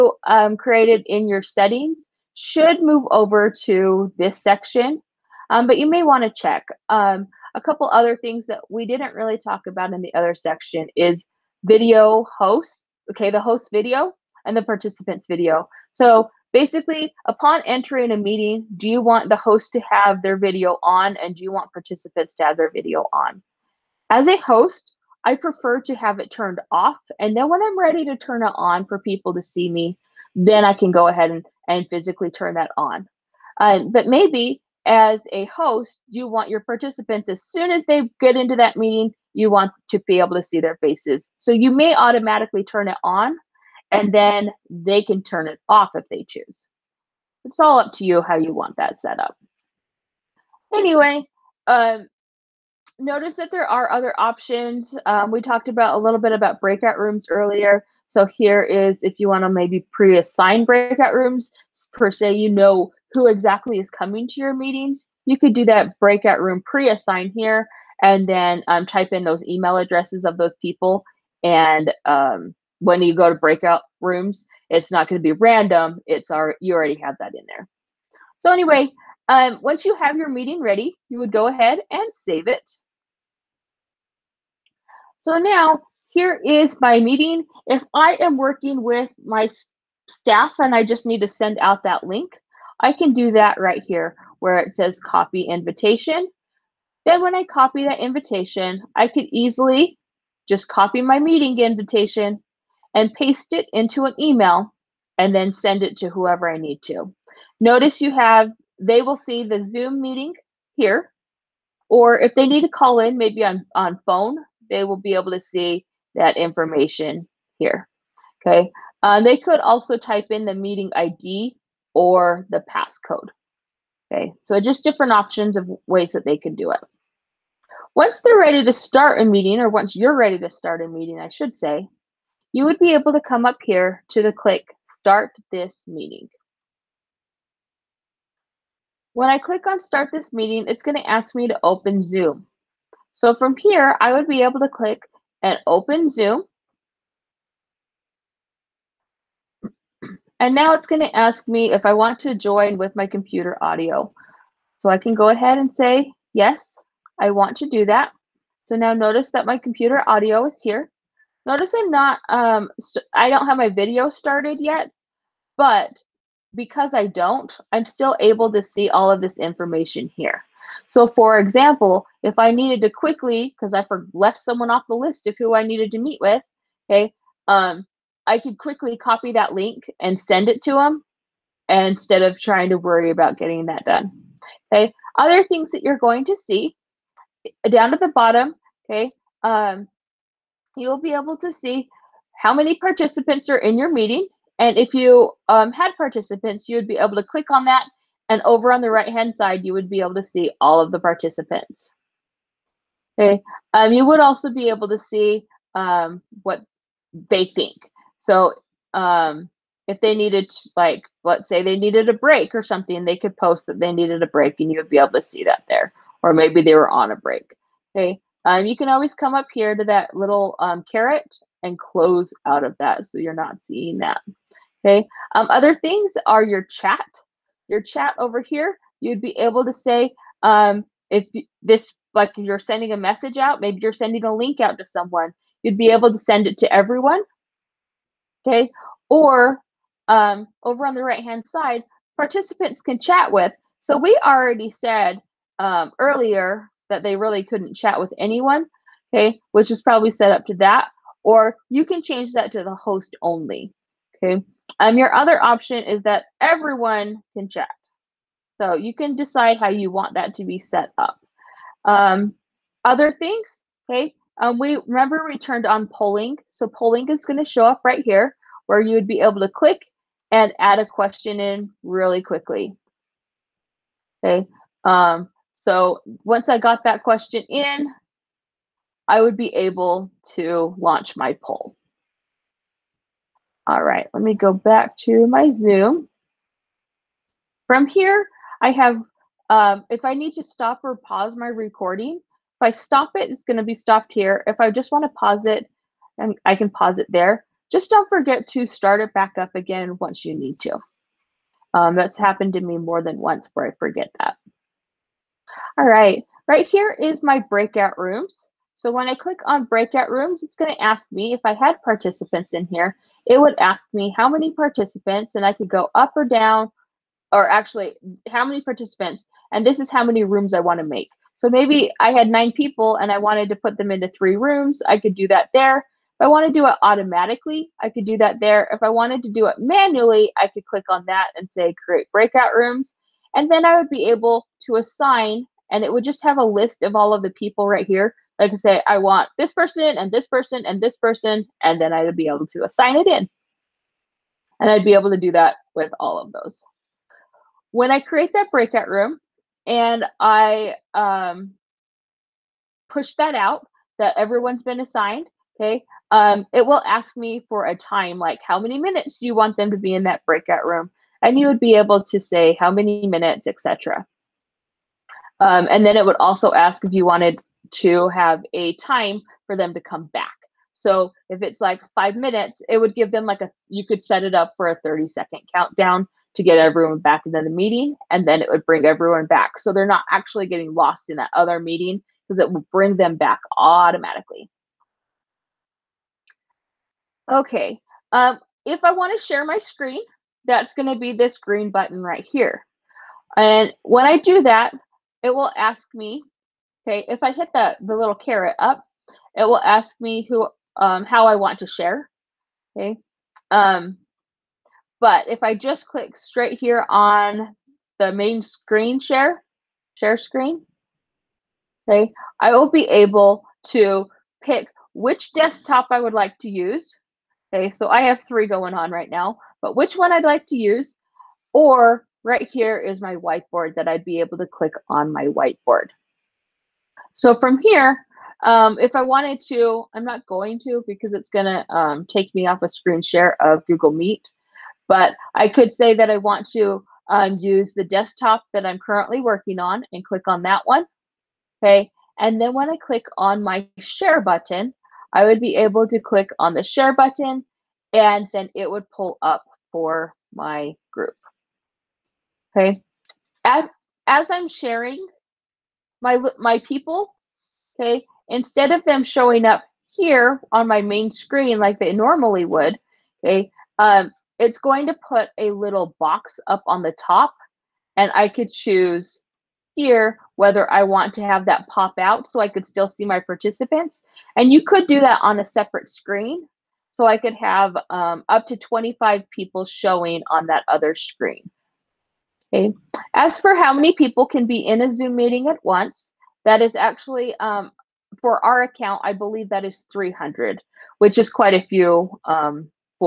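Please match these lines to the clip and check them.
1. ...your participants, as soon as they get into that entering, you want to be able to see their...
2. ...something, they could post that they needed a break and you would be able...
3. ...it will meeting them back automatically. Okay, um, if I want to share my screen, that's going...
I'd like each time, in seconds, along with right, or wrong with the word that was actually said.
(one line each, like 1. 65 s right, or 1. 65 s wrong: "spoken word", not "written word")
1. 36 s wrong: "meeting", not "entering"
2. 212 s right
3. 382 s wrong: "bring", not "meeting".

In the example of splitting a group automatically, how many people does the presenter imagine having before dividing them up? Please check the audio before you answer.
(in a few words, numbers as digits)
9.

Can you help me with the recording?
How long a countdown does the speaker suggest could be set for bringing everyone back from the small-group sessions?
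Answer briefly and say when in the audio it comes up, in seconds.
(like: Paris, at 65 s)
30 seconds, at 374 s.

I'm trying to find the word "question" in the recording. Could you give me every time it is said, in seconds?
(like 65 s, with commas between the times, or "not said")
270 s, 277 s.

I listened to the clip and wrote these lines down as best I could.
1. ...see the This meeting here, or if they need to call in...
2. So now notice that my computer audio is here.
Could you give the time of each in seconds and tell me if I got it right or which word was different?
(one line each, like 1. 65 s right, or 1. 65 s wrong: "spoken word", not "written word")
1. 109 s wrong: "Zoom", not "This"
2. 158 s right.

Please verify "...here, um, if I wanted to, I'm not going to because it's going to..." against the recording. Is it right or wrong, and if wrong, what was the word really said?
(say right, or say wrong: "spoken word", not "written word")
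right.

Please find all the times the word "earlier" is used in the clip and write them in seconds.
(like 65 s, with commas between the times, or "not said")
57 s, 245 s.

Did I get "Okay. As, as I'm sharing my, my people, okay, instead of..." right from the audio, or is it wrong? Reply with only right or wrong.
right.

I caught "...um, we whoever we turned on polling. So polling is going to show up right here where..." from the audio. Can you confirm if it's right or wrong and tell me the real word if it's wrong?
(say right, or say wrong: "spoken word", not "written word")
wrong: "remember", not "whoever".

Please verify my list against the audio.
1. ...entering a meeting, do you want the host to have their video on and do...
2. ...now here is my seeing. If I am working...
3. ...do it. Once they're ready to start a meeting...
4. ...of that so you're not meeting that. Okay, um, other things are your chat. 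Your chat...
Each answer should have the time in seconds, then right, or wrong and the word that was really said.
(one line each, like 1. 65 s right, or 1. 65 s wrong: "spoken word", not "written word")
1. 17 s right
2. 85 s wrong: "meeting", not "seeing"
3. 126 s right
4. 222 s wrong: "seeing", not "meeting".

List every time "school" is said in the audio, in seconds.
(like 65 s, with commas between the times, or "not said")
not said.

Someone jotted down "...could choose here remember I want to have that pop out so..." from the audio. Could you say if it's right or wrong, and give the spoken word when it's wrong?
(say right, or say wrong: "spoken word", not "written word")
wrong: "whether", not "remember".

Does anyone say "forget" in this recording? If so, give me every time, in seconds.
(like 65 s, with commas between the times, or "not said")
298 s, 303 s.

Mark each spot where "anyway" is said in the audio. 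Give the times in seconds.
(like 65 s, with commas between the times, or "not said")
50 s, 78 s.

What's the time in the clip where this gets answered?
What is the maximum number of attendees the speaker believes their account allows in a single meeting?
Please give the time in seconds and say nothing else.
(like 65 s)
489 s.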